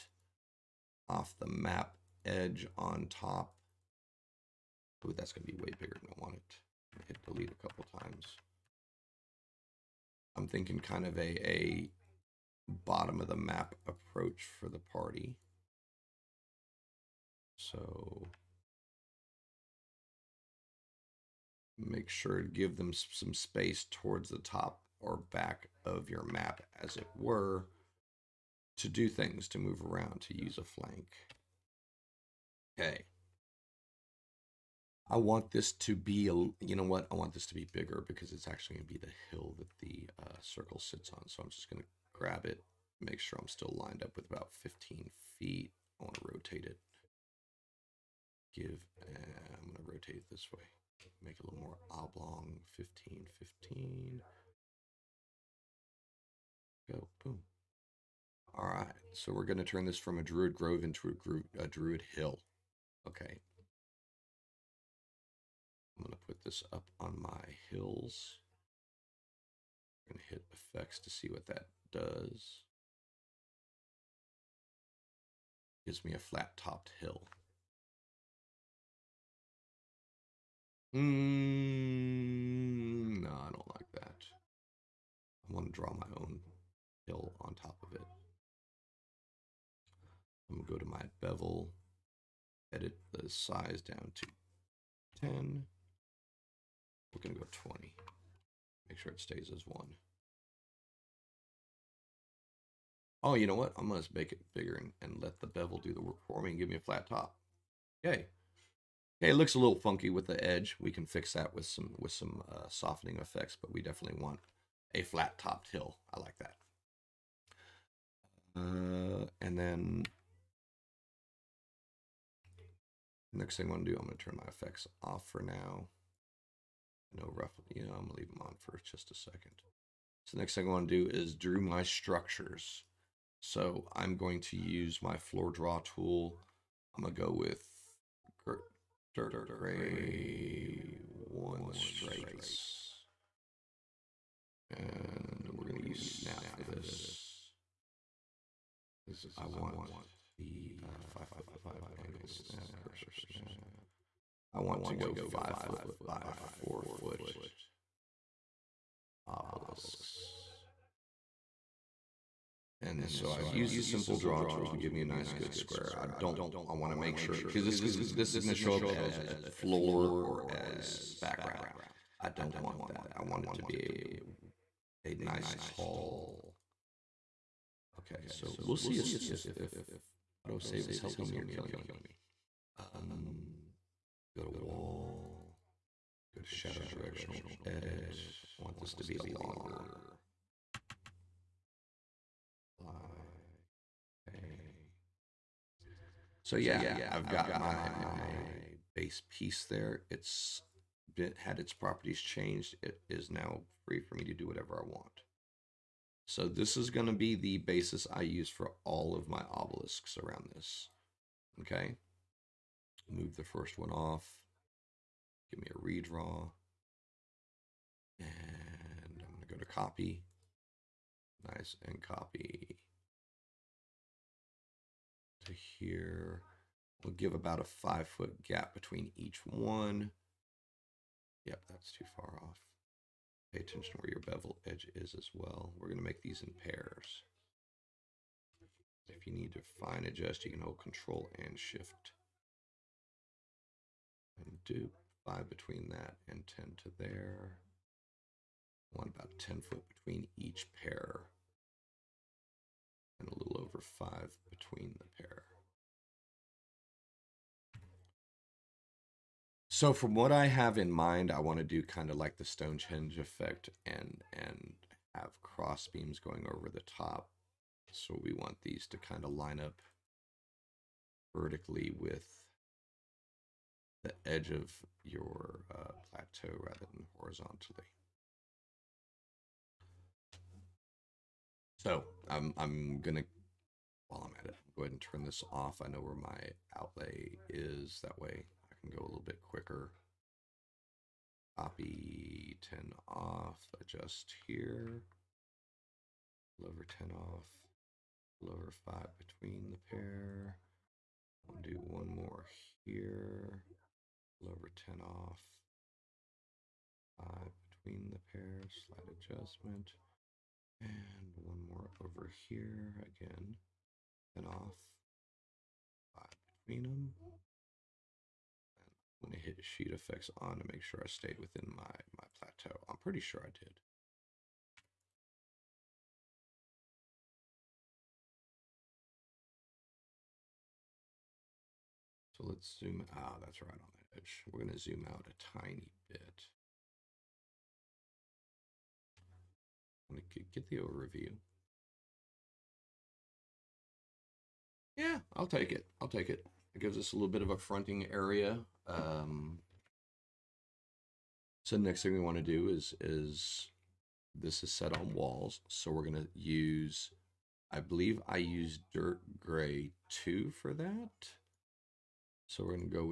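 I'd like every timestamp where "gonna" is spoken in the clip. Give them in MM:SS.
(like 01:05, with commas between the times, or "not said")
02:08, 02:17, 02:25, 04:43.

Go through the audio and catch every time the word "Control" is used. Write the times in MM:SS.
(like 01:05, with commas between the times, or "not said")
04:00.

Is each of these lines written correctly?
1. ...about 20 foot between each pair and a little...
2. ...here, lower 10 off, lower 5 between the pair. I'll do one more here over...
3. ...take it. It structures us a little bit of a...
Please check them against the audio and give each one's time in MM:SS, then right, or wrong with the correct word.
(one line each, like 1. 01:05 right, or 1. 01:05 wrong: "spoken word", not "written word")
1. 04:09 wrong: "10", not "20"
2. 04:54 right
3. 05:46 wrong: "gives", not "structures".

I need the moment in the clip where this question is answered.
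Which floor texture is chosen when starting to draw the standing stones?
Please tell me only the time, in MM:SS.
02:19.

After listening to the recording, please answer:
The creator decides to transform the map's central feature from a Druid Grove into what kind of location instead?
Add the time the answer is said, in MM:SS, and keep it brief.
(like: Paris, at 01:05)
Druid Hill, at 01:01.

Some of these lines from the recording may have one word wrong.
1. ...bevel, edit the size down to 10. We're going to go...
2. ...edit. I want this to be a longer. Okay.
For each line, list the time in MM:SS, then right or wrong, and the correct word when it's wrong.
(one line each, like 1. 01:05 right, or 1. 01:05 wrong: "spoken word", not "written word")
1. 01:31 right
2. 03:07 right.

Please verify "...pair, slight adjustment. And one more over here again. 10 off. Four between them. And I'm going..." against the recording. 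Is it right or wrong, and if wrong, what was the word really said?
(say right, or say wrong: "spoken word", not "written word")
wrong: "Five", not "Four".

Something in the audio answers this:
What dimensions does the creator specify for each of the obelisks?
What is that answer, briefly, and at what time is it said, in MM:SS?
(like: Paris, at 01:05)
5 foot by 4 foot, at 02:35.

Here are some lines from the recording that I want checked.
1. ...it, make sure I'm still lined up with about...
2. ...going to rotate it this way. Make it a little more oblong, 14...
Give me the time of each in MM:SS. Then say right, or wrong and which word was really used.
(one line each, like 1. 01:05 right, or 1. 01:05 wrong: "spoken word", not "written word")
1. 00:42 right
2. 00:49 wrong: "15", not "14".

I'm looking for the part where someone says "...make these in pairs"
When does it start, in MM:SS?
03:56.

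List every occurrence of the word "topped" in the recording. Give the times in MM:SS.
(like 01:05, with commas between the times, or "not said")
01:16, 01:55.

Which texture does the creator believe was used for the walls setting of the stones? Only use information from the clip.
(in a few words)
dirt gray 2.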